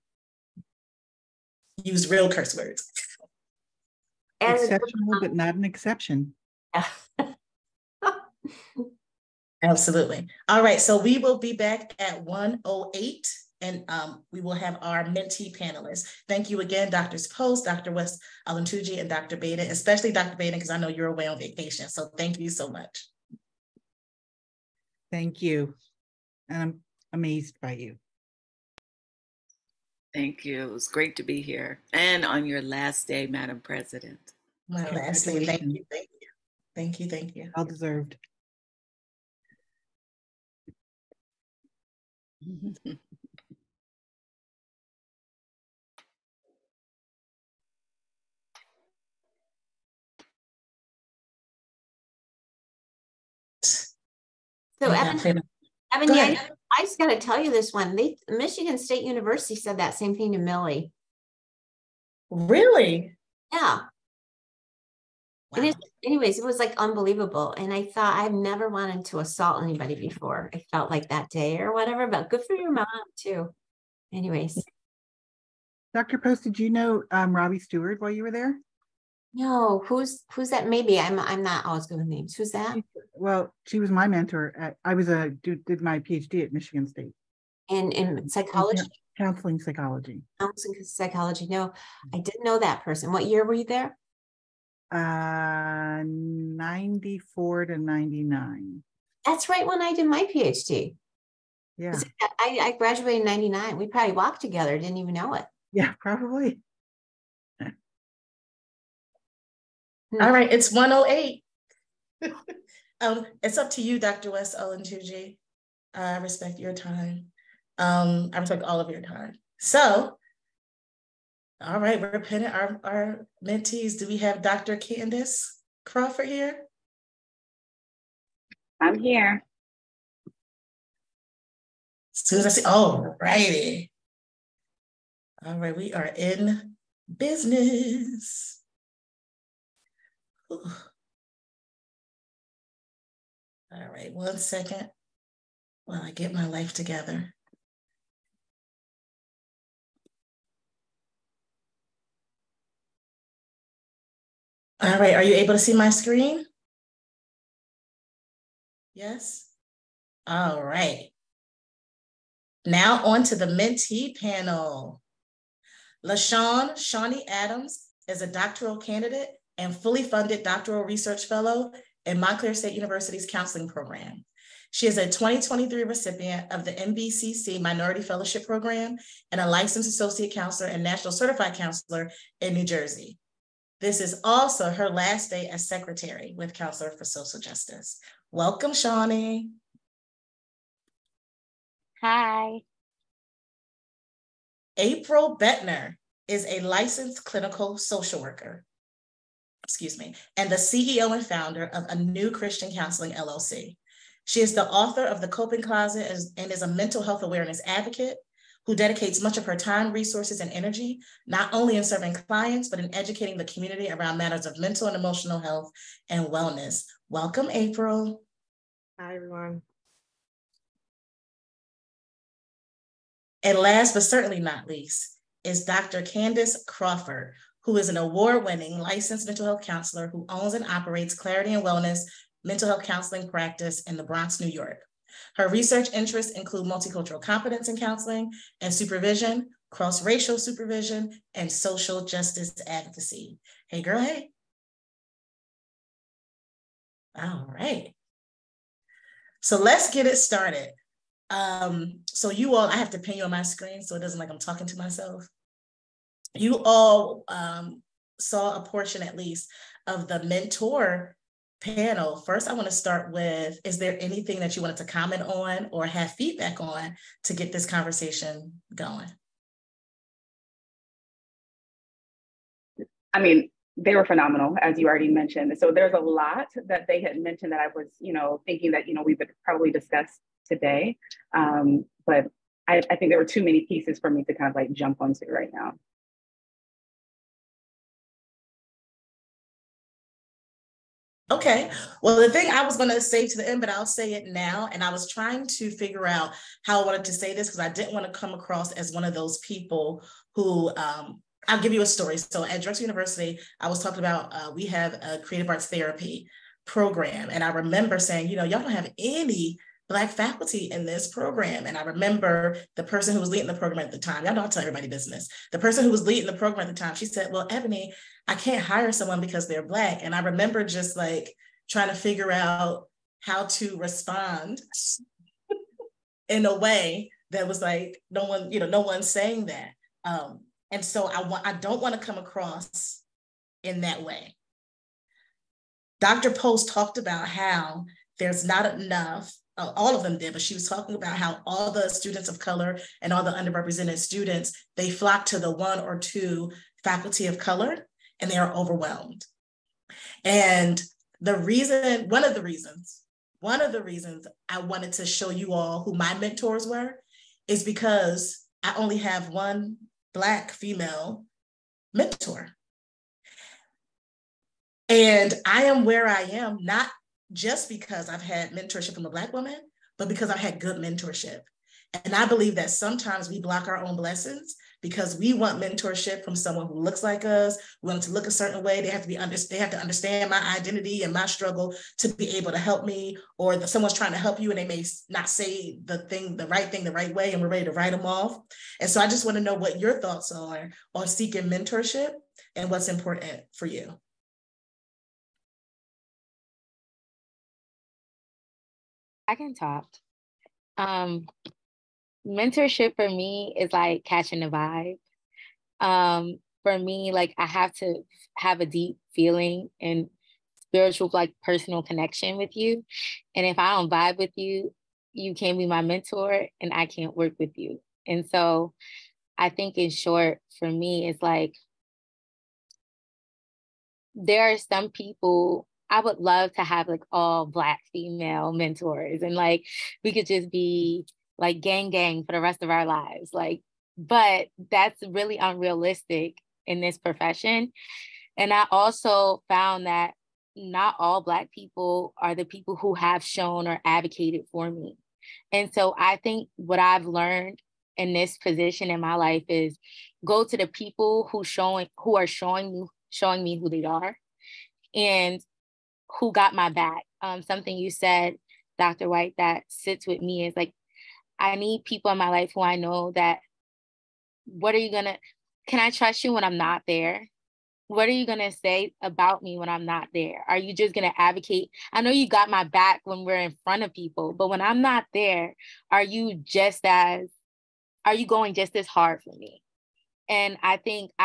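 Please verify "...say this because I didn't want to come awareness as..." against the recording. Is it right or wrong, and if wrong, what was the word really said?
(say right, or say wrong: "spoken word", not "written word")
wrong: "across", not "awareness".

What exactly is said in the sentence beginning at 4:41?
Um, but I, I think there were too many pieces for me to kind of like jump onto right now.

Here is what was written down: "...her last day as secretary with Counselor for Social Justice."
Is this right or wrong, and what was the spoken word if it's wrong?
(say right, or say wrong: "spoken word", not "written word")
right.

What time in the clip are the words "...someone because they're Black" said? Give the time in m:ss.
5:18.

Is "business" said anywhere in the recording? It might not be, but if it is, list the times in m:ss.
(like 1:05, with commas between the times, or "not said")
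2:17, 5:14.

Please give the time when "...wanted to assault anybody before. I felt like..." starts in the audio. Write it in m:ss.
1:08.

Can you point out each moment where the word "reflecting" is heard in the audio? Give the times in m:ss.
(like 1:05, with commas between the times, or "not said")
not said.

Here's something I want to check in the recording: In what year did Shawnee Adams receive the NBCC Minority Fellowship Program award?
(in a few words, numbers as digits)
2023.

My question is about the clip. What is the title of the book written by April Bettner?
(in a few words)
The Coping Closet.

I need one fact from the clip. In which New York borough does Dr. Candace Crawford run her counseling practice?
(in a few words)
the Bronx.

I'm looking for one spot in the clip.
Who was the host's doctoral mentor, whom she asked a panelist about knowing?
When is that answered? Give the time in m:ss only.
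1:17.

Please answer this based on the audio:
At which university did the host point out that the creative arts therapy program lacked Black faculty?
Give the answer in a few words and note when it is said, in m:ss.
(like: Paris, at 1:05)
Drexel University, at 5:02.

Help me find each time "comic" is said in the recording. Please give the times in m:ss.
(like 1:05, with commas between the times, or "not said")
not said.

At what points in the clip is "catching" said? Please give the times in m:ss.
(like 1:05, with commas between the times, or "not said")
6:44.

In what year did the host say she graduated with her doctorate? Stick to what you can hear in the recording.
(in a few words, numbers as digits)
1999.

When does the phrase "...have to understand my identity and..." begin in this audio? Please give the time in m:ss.
6:19.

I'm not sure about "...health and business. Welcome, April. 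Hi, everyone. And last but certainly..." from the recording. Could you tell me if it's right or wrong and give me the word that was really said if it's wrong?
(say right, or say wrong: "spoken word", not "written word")
wrong: "wellness", not "business".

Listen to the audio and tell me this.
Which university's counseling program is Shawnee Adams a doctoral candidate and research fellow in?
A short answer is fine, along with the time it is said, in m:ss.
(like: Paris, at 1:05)
Montclair State University, at 2:52.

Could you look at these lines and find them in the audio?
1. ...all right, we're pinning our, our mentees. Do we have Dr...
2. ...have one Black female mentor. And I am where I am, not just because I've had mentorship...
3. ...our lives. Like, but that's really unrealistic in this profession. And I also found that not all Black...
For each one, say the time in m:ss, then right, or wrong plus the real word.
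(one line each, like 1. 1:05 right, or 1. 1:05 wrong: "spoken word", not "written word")
1. 2:01 right
2. 5:58 right
3. 7:12 right.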